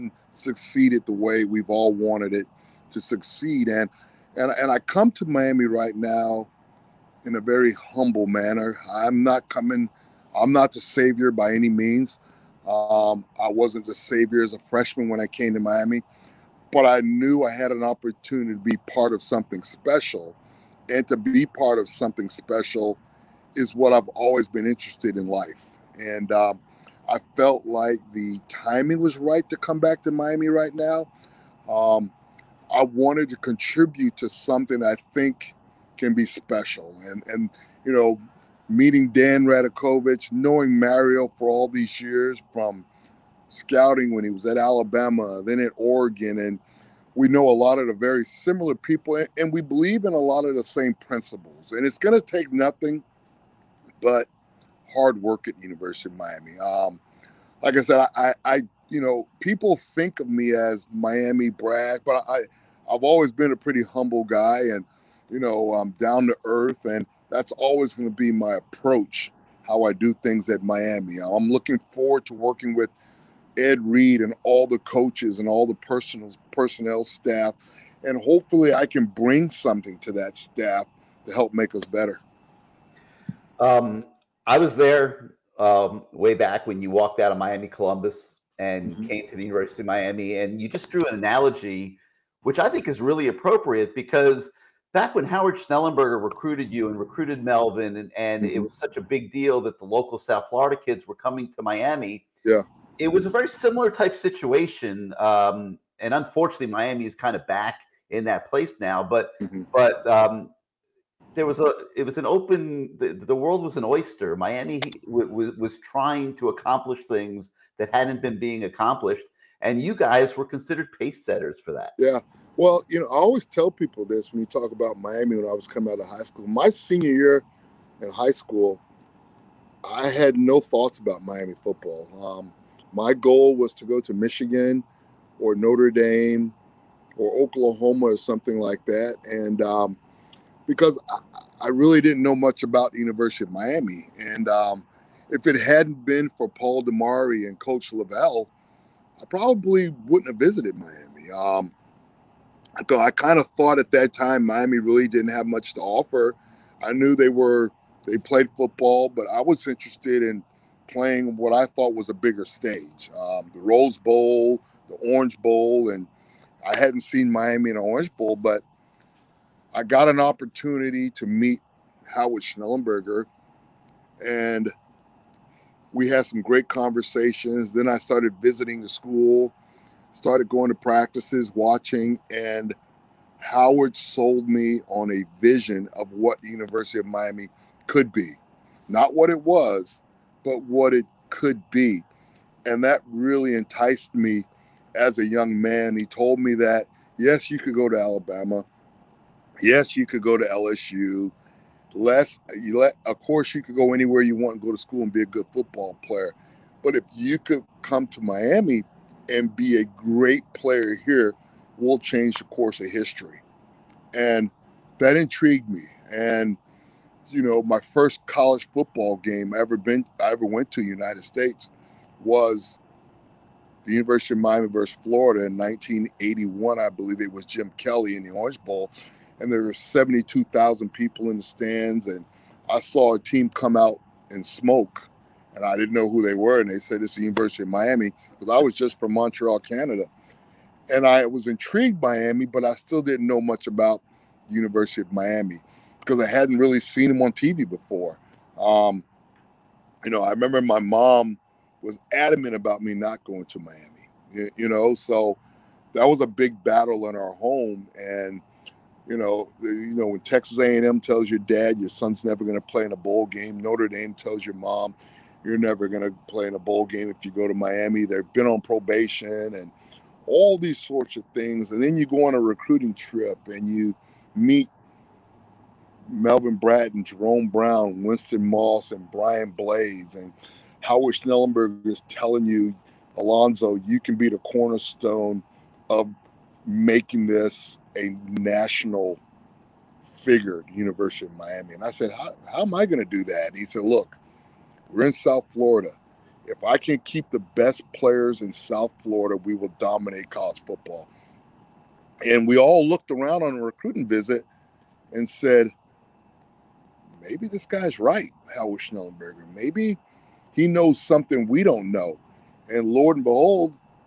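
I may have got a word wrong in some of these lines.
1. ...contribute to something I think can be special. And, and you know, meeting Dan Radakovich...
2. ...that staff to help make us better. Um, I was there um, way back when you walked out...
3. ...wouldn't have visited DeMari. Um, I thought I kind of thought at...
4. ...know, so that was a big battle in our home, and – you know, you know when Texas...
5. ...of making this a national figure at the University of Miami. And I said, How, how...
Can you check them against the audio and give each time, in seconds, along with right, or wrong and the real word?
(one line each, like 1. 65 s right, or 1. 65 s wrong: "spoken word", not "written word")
1. 33 s right
2. 80 s right
3. 150 s wrong: "Miami", not "DeMari"
4. 254 s right
5. 285 s right.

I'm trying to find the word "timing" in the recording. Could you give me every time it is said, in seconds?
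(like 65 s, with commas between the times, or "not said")
28 s.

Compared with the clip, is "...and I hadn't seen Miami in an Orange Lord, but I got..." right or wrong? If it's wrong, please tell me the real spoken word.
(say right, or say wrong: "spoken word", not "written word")
wrong: "Bowl", not "Lord".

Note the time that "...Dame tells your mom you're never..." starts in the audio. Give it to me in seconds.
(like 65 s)
263 s.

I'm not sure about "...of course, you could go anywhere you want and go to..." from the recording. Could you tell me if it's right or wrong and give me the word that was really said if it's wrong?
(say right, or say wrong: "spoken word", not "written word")
right.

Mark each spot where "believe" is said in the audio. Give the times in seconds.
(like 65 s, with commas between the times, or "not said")
49 s, 226 s.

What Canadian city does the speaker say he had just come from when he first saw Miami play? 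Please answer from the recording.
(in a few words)
Montreal.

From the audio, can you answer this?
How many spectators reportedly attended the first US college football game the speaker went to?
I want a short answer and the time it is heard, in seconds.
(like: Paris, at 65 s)
72,000, at 229 s.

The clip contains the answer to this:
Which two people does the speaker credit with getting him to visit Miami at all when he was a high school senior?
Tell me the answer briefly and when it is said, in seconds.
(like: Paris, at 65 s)
Paul DeMari and Coach Lavelle, at 146 s.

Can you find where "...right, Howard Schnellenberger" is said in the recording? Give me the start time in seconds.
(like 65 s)
307 s.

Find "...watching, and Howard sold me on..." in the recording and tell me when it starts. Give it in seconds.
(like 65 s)
181 s.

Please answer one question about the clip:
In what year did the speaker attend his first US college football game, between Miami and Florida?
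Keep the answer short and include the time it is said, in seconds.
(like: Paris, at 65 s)
1981, at 225 s.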